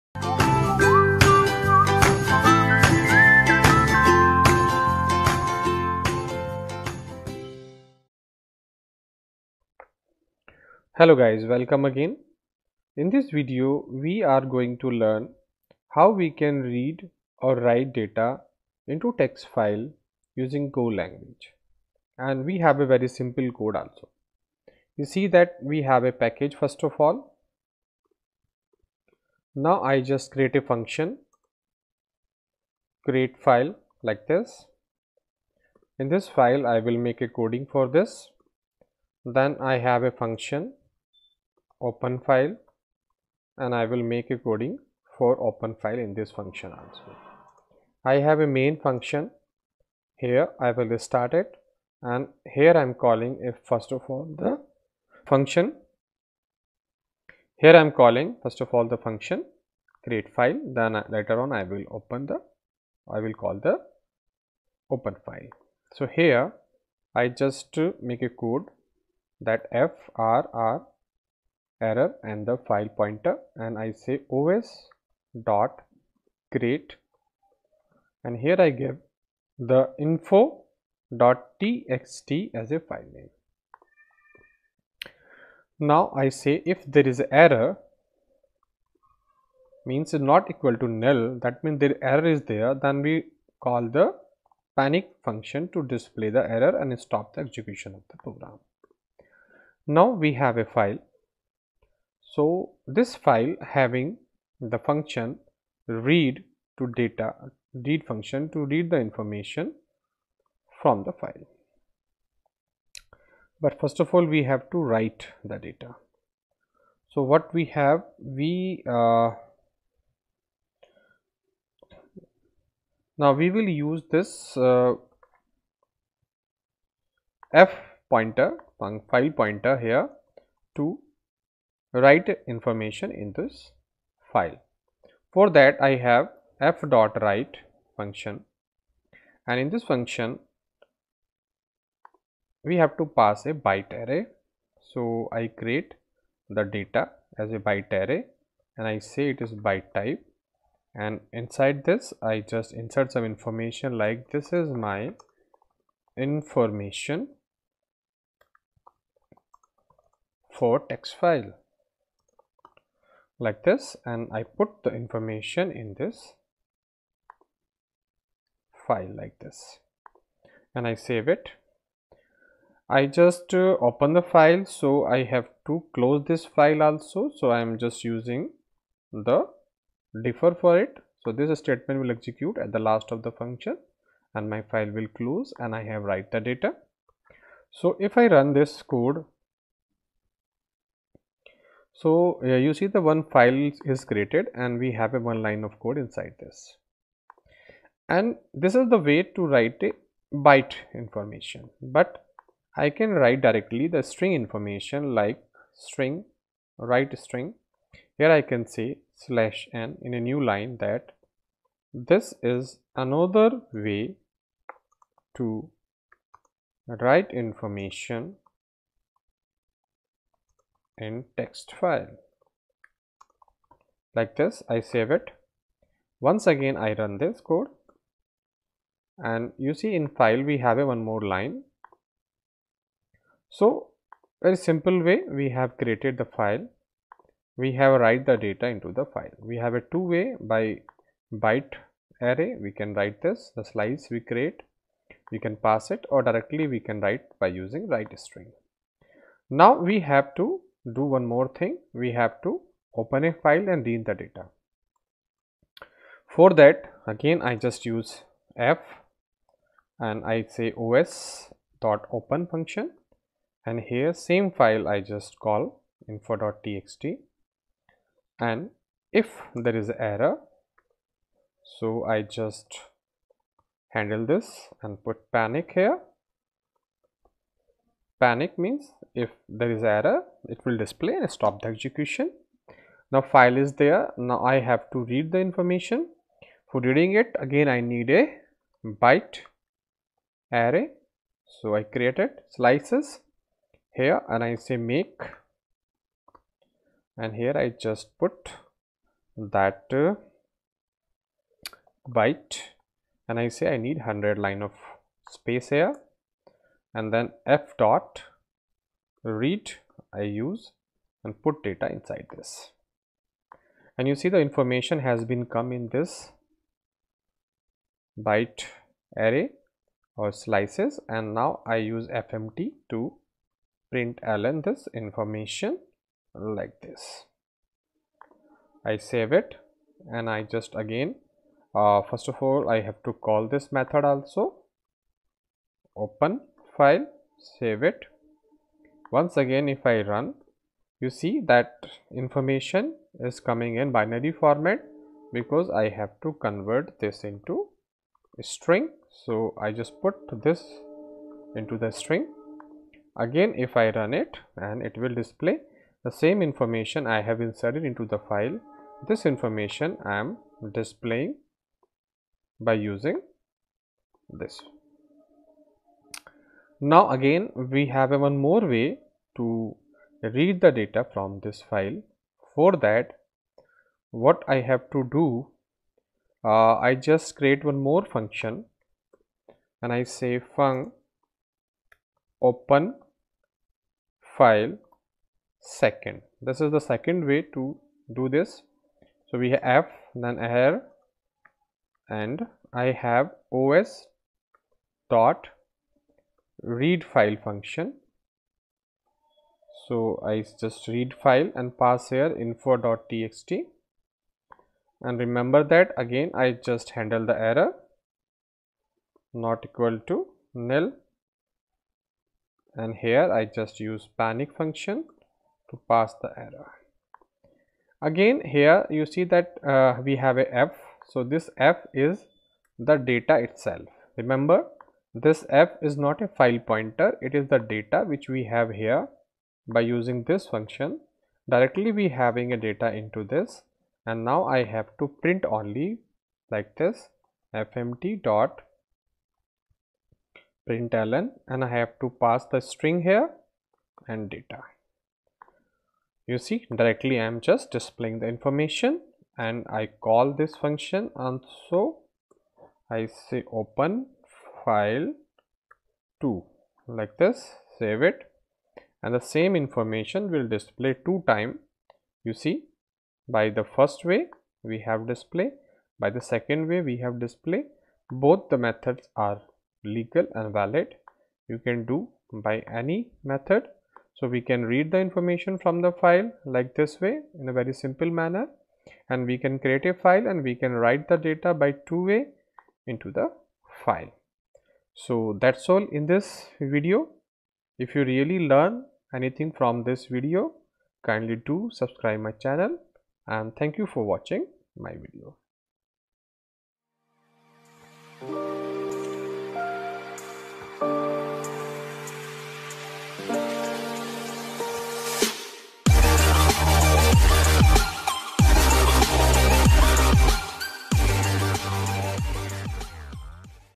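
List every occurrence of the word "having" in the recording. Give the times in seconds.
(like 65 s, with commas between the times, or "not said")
103 s, 432 s.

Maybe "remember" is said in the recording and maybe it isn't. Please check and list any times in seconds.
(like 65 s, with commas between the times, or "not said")
405 s, 424 s.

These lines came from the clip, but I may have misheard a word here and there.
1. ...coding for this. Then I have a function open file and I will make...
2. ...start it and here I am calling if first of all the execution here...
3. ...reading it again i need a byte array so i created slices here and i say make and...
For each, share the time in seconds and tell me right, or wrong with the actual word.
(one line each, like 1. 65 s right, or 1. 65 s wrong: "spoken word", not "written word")
1. 37 s right
2. 50 s wrong: "function", not "execution"
3. 286 s right.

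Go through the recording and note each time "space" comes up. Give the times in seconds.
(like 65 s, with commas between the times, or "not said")
305 s.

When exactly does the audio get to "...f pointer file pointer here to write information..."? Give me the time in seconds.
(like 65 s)
127 s.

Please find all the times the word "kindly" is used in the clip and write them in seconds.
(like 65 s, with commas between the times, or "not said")
491 s.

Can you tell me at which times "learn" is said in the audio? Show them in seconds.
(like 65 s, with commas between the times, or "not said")
14 s, 488 s.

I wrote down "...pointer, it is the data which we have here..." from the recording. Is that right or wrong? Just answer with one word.
right.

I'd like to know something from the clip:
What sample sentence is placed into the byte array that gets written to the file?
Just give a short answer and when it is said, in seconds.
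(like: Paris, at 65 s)
This is my information for text file, at 154 s.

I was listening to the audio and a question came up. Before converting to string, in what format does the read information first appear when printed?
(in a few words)
binary format.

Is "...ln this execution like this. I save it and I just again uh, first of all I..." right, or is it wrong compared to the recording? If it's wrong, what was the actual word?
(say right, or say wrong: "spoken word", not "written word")
wrong: "information", not "execution".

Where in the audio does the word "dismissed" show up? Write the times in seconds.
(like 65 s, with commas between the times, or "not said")
not said.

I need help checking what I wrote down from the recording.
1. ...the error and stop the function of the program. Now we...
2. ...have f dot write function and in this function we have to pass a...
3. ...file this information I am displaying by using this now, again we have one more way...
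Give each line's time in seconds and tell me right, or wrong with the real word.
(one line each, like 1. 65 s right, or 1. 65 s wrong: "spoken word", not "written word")
1. 96 s wrong: "execution", not "function"
2. 135 s right
3. 358 s right.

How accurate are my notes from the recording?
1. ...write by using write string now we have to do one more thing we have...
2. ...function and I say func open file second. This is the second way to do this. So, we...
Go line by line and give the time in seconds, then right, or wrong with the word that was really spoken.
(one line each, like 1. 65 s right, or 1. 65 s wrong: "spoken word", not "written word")
1. 246 s right
2. 378 s right.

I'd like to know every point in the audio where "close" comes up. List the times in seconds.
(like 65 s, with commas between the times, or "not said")
175 s, 185 s.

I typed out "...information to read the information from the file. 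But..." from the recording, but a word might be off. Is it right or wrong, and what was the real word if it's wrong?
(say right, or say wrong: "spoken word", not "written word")
wrong: "function", not "information".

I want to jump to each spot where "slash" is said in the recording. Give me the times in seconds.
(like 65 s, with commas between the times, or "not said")
209 s.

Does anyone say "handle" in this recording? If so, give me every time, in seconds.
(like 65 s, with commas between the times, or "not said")
273 s, 406 s.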